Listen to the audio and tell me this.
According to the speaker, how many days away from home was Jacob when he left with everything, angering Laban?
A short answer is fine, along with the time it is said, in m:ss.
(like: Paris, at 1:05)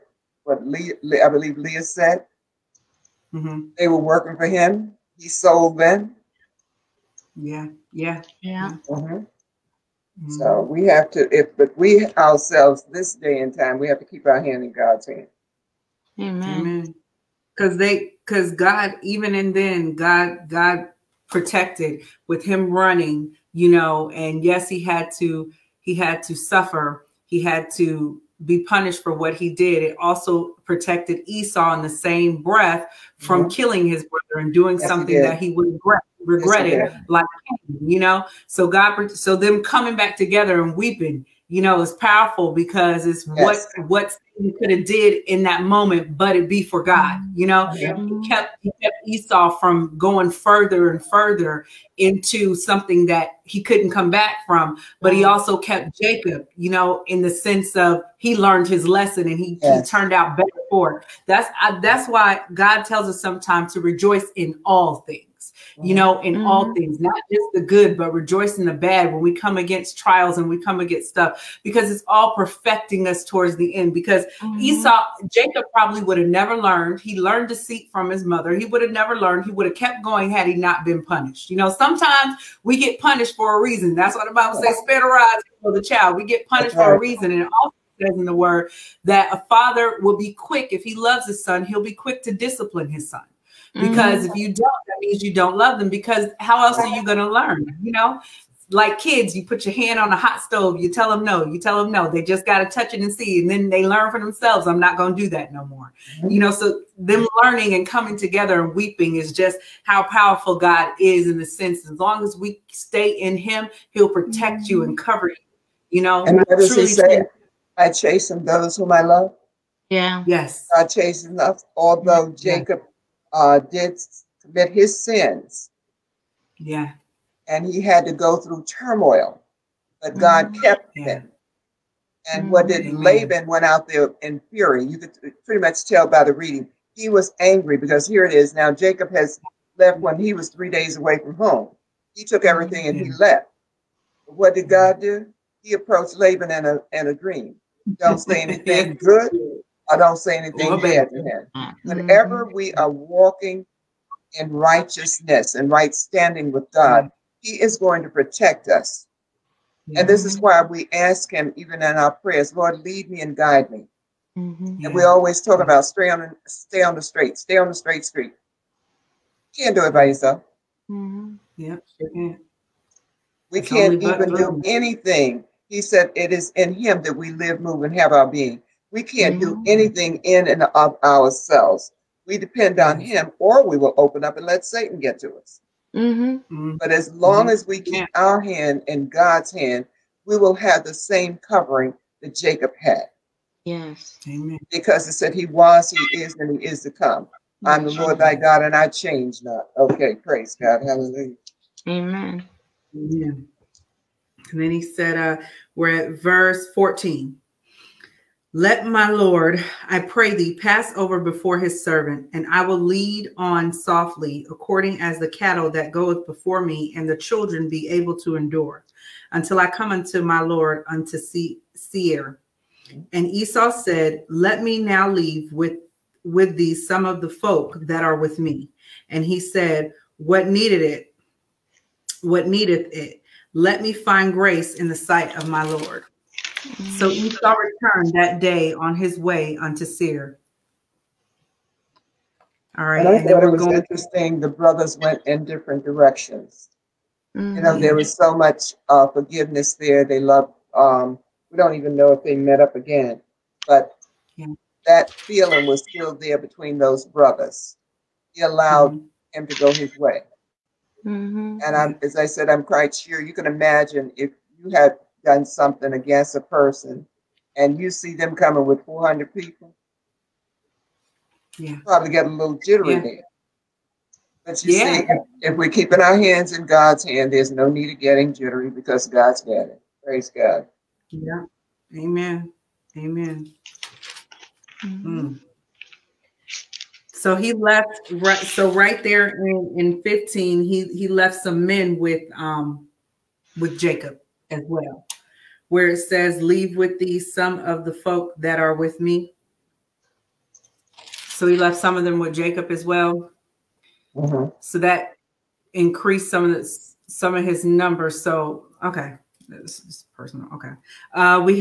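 3, at 2:20.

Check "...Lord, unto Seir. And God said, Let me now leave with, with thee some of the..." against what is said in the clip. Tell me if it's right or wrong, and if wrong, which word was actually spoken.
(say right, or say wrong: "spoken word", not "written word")
wrong: "Esau", not "God".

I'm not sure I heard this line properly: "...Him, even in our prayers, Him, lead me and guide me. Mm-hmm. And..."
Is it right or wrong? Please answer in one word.
wrong.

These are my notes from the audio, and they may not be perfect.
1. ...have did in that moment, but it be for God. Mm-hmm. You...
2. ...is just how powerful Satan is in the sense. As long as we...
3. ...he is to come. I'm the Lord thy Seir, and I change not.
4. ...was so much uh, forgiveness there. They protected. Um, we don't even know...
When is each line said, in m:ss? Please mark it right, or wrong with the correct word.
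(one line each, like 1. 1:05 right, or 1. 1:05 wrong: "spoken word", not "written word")
1. 0:44 right
2. 1:49 wrong: "God", not "Satan"
3. 3:16 wrong: "God", not "Seir"
4. 4:07 wrong: "loved", not "protected".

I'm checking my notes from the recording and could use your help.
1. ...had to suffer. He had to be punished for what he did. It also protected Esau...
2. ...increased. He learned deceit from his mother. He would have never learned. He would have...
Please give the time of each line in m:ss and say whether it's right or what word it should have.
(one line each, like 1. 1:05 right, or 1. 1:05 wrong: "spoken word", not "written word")
1. 0:25 right
2. 1:16 wrong: "learned", not "increased".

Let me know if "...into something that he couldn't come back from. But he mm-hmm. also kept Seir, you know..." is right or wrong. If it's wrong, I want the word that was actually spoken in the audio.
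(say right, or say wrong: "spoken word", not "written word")
wrong: "Jacob", not "Seir".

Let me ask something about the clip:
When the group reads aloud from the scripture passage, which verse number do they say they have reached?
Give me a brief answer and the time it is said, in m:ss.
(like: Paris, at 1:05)
14, at 3:26.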